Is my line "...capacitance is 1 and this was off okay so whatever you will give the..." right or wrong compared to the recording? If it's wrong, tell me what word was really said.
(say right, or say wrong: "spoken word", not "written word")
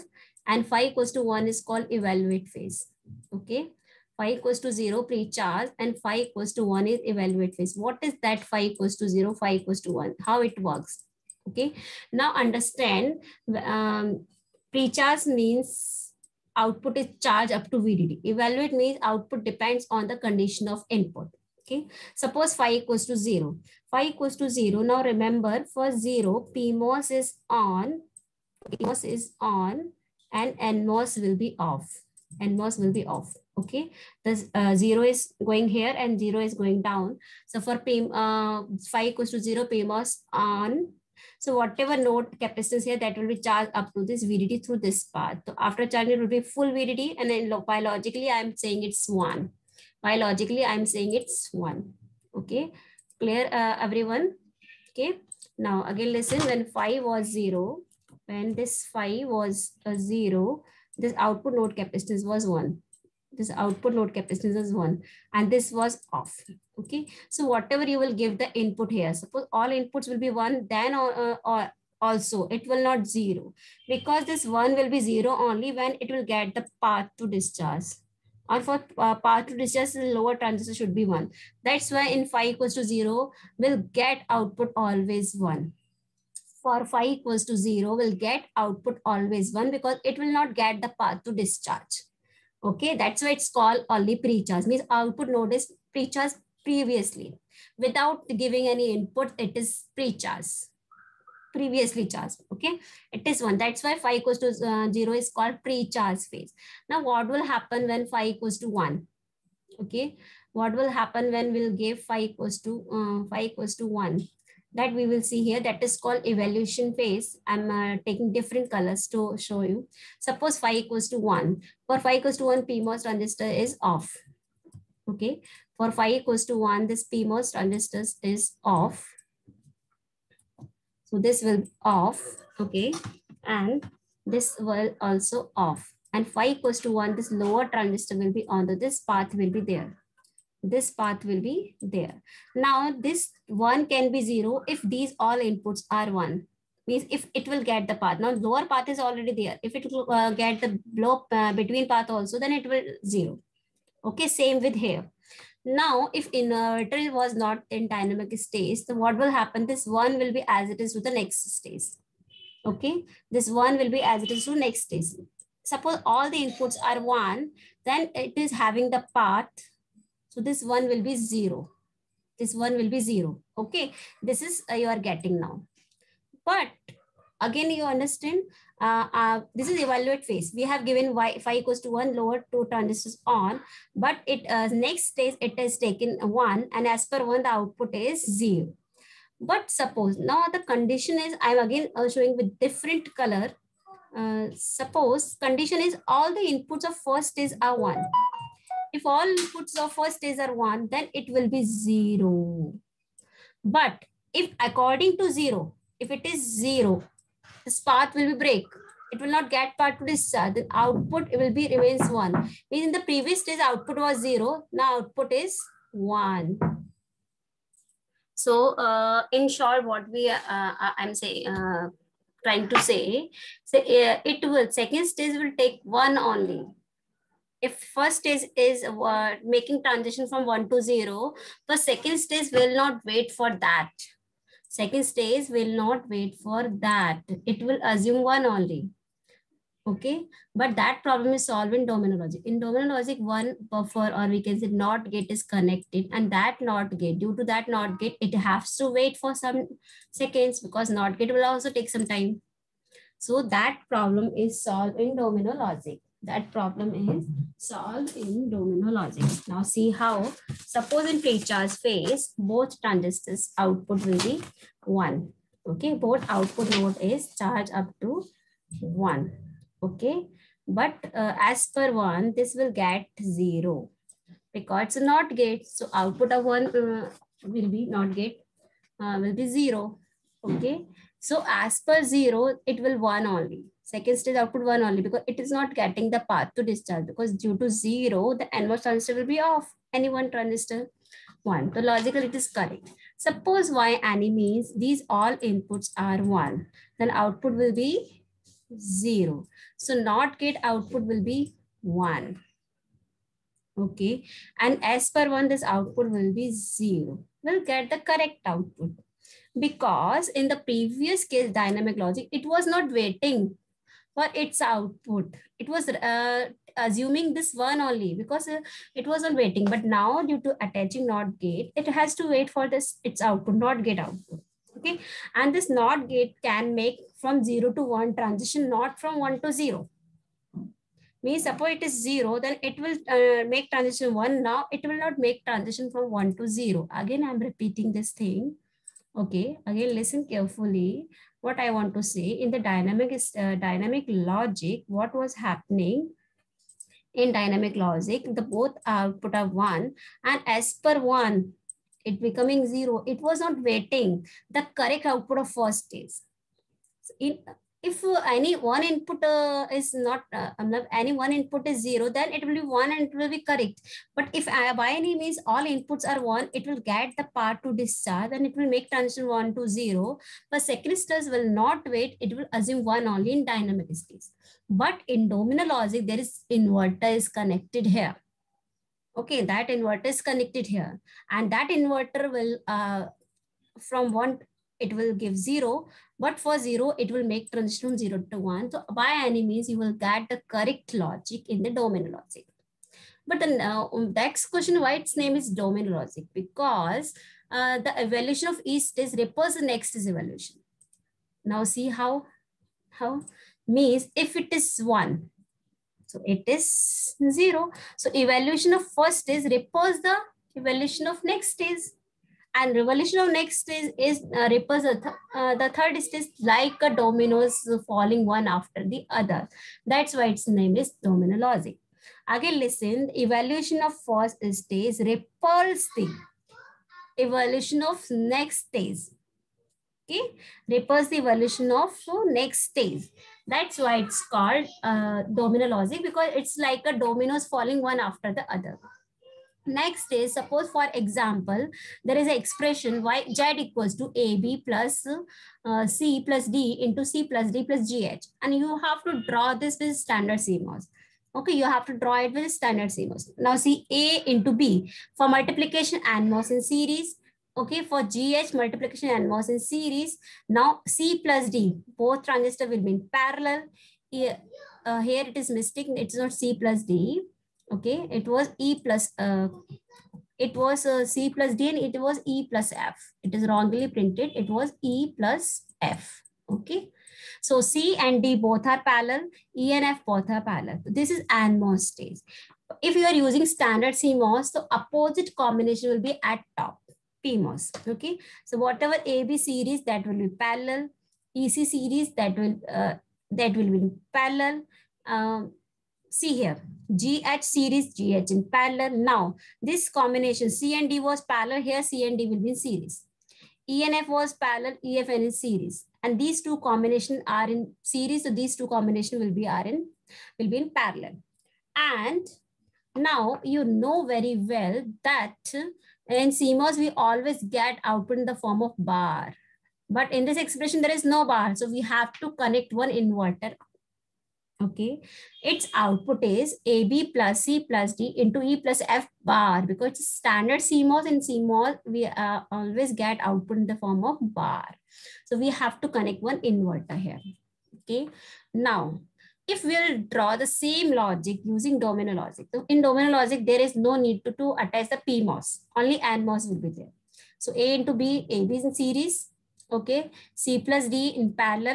right.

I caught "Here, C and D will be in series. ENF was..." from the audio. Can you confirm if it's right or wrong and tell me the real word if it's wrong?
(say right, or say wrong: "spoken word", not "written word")
right.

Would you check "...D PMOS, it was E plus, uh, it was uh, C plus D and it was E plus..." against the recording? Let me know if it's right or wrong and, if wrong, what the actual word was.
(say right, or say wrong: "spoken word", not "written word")
wrong: "Okay", not "PMOS".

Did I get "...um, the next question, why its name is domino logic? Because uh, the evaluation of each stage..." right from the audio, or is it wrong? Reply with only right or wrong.
right.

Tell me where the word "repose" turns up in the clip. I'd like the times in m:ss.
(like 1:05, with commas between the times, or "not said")
6:39, 6:49.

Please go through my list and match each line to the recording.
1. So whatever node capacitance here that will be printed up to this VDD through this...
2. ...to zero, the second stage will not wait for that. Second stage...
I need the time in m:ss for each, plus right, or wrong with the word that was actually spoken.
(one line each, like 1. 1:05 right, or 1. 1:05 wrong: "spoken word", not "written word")
1. 0:41 wrong: "charged", not "printed"
2. 3:50 right.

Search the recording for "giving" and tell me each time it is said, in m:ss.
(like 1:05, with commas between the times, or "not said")
1:38.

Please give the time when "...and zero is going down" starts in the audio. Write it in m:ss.
0:35.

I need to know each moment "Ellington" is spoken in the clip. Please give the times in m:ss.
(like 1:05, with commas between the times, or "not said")
not said.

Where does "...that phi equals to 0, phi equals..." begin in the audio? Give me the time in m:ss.
0:08.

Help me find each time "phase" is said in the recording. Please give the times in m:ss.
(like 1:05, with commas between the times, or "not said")
0:02, 0:07, 1:46, 1:56, 3:00, 4:21.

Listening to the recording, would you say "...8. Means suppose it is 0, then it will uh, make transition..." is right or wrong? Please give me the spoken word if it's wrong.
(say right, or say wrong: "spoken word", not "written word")
wrong: "0", not "8".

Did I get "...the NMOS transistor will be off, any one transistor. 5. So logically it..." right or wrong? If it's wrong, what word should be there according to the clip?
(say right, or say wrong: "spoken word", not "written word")
wrong: "1", not "5".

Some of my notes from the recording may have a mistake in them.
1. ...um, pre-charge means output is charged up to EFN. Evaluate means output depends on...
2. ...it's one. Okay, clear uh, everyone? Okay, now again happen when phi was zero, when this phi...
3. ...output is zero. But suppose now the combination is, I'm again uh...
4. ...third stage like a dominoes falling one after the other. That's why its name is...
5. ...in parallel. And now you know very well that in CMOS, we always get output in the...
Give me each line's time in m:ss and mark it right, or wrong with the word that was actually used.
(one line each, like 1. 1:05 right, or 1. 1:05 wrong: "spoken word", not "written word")
1. 0:13 wrong: "VDD", not "EFN"
2. 0:51 wrong: "listen", not "happen"
3. 3:07 wrong: "condition", not "combination"
4. 6:55 right
5. 8:30 right.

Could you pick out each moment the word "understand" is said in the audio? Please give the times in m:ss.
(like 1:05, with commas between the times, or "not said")
0:12, 2:57.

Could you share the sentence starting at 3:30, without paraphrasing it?
Uh, then output it will be remains 1.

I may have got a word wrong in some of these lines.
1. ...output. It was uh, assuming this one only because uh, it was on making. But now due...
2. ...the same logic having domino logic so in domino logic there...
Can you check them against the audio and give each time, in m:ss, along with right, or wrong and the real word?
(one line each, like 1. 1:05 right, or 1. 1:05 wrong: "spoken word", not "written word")
1. 5:14 wrong: "waiting", not "making"
2. 9:00 wrong: "using", not "having".